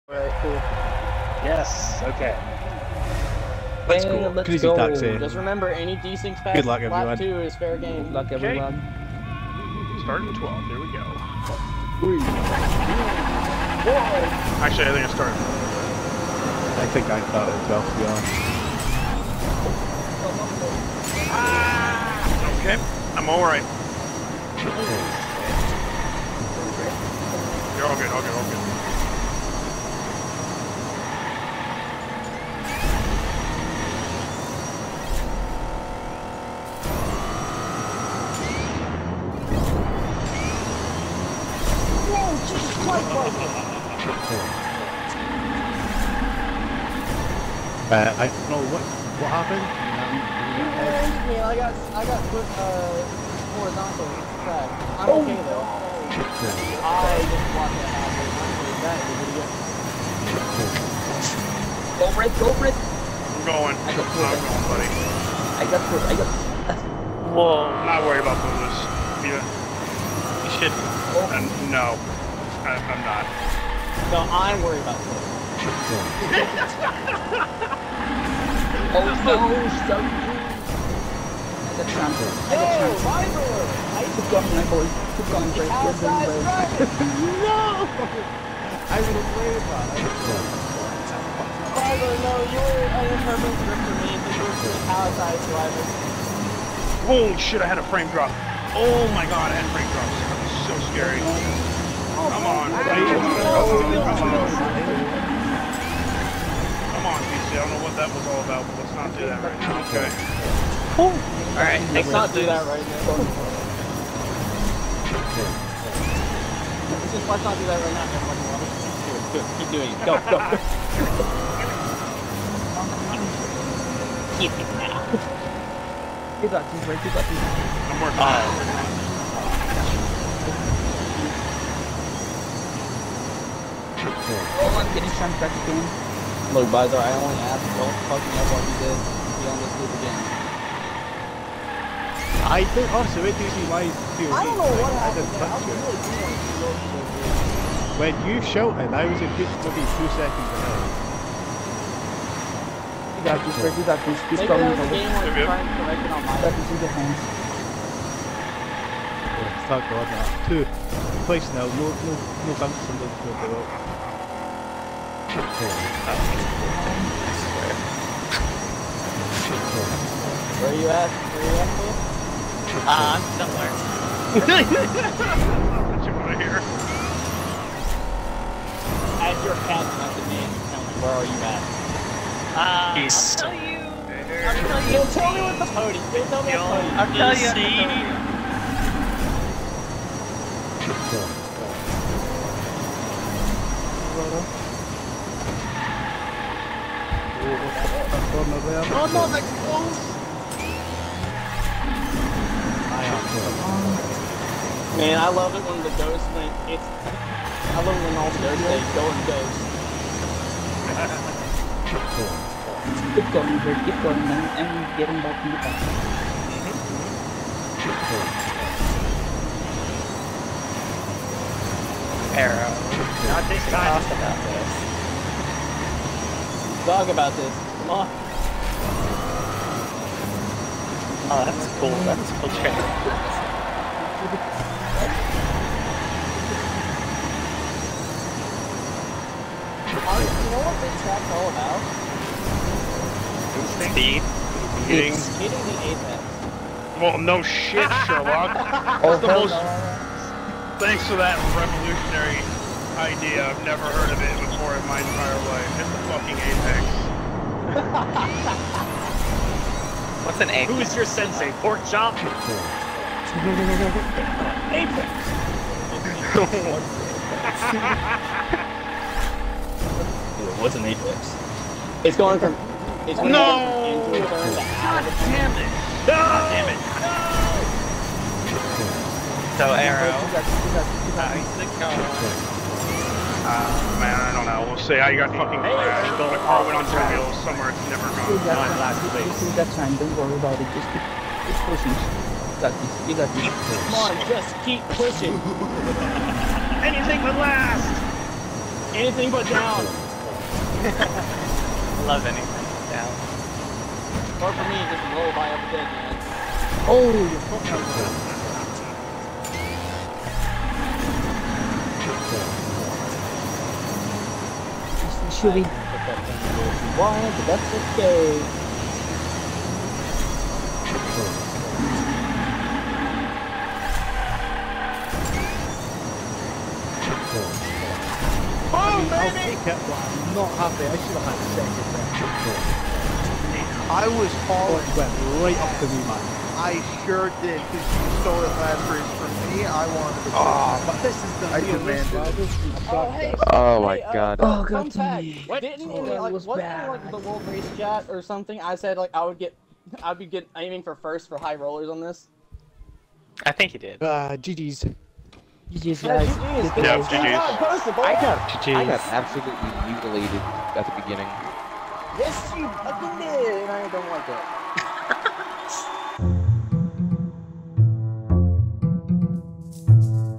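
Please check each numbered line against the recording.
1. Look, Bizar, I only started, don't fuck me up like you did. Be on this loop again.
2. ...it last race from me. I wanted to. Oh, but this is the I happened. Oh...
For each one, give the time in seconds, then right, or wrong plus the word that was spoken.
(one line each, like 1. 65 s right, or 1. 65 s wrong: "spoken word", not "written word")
1. 134 s wrong: "asked", not "started"
2. 338 s wrong: "demanded", not "happened".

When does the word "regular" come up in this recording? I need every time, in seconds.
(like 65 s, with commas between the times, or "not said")
not said.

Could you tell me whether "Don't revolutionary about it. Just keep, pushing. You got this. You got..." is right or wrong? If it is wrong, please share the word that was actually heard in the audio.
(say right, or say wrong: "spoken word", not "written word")
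wrong: "worry", not "revolutionary".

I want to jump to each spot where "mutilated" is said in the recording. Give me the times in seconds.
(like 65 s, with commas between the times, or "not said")
359 s.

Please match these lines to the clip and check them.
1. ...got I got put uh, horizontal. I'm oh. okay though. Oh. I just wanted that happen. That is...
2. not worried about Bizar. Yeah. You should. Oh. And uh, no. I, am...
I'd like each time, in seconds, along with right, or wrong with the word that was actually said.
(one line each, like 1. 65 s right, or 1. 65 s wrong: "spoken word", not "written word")
1. 51 s wrong: "watched", not "wanted"
2. 67 s wrong: "Buddhas", not "Bizar".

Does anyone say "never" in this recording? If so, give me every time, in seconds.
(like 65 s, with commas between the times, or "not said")
253 s, 287 s.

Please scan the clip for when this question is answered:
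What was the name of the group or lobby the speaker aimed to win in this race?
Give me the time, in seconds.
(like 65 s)
351 s.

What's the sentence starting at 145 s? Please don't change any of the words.
I was when you shouted, I was a good maybe two seconds ahead.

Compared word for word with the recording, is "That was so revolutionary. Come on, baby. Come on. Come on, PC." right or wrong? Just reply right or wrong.
wrong.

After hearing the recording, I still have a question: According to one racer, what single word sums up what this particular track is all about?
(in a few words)
Speed.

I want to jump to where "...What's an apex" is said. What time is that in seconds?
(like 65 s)
270 s.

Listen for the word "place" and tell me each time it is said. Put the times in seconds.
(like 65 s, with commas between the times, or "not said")
161 s, 289 s.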